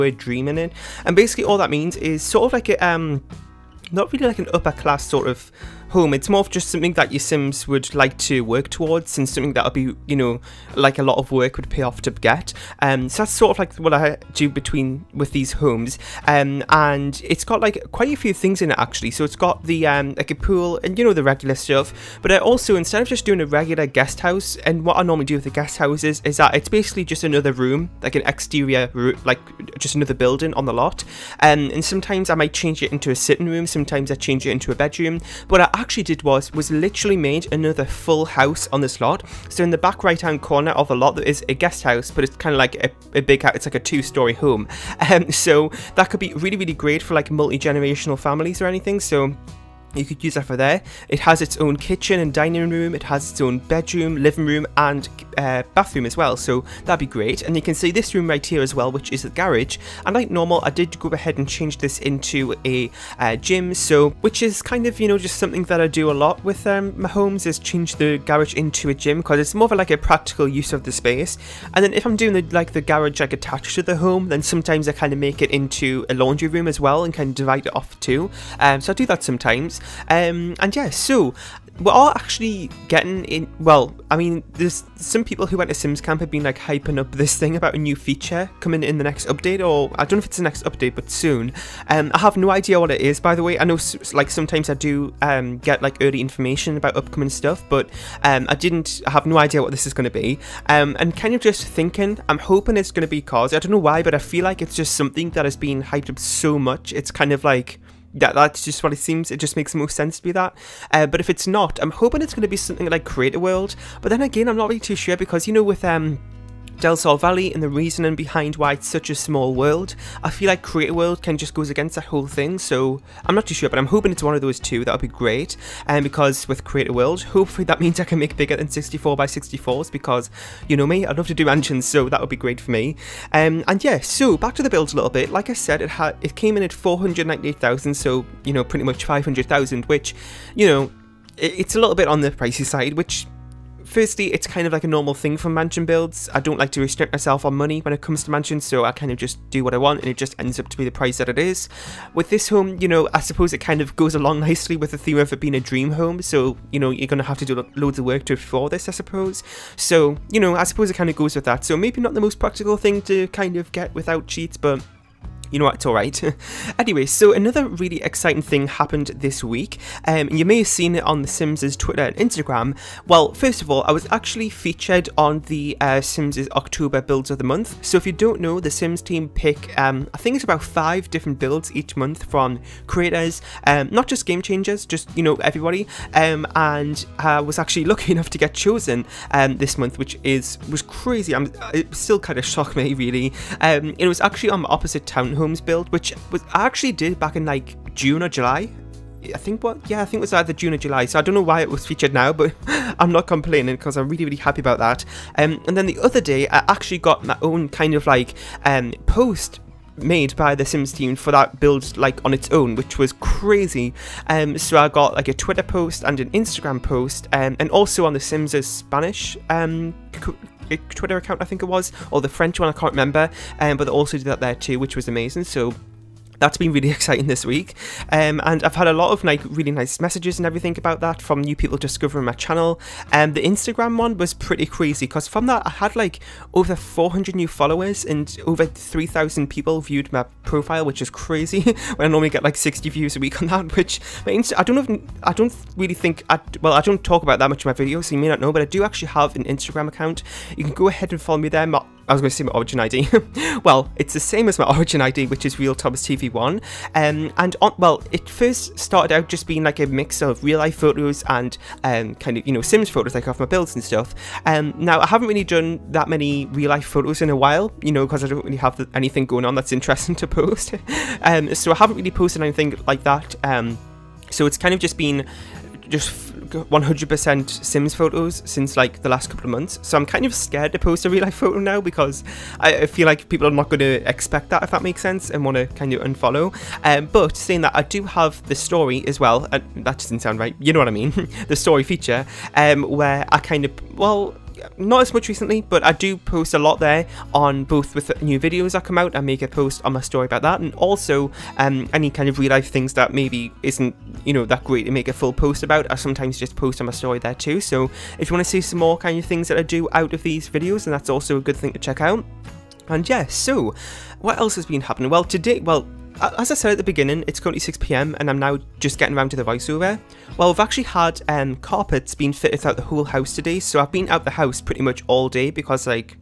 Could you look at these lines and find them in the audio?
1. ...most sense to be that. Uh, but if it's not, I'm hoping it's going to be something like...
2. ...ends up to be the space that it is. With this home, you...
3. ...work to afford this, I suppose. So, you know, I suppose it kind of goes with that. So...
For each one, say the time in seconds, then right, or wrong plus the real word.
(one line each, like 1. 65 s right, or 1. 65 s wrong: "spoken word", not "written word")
1. 109 s right
2. 150 s wrong: "price", not "space"
3. 158 s right.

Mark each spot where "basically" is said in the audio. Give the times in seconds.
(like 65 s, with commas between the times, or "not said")
1 s, 26 s.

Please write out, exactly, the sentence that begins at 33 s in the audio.
Sometimes I change it into a bedroom.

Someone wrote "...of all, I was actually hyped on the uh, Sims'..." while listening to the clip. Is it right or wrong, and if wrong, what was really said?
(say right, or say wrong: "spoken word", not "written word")
wrong: "featured", not "hyped".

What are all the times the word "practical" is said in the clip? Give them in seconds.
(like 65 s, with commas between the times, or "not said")
69 s, 162 s.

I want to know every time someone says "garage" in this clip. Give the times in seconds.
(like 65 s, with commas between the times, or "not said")
59 s, 68 s, 72 s.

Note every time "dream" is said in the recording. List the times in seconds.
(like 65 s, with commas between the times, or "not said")
0 s, 155 s.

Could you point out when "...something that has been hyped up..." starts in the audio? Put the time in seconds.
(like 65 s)
104 s.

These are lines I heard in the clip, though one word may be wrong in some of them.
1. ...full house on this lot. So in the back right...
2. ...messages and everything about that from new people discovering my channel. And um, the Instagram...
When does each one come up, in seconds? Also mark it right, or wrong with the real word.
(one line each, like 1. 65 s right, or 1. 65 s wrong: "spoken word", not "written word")
1. 37 s right
2. 230 s right.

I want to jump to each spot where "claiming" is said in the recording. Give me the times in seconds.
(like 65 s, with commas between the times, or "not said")
not said.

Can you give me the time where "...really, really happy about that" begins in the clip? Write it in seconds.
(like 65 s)
204 s.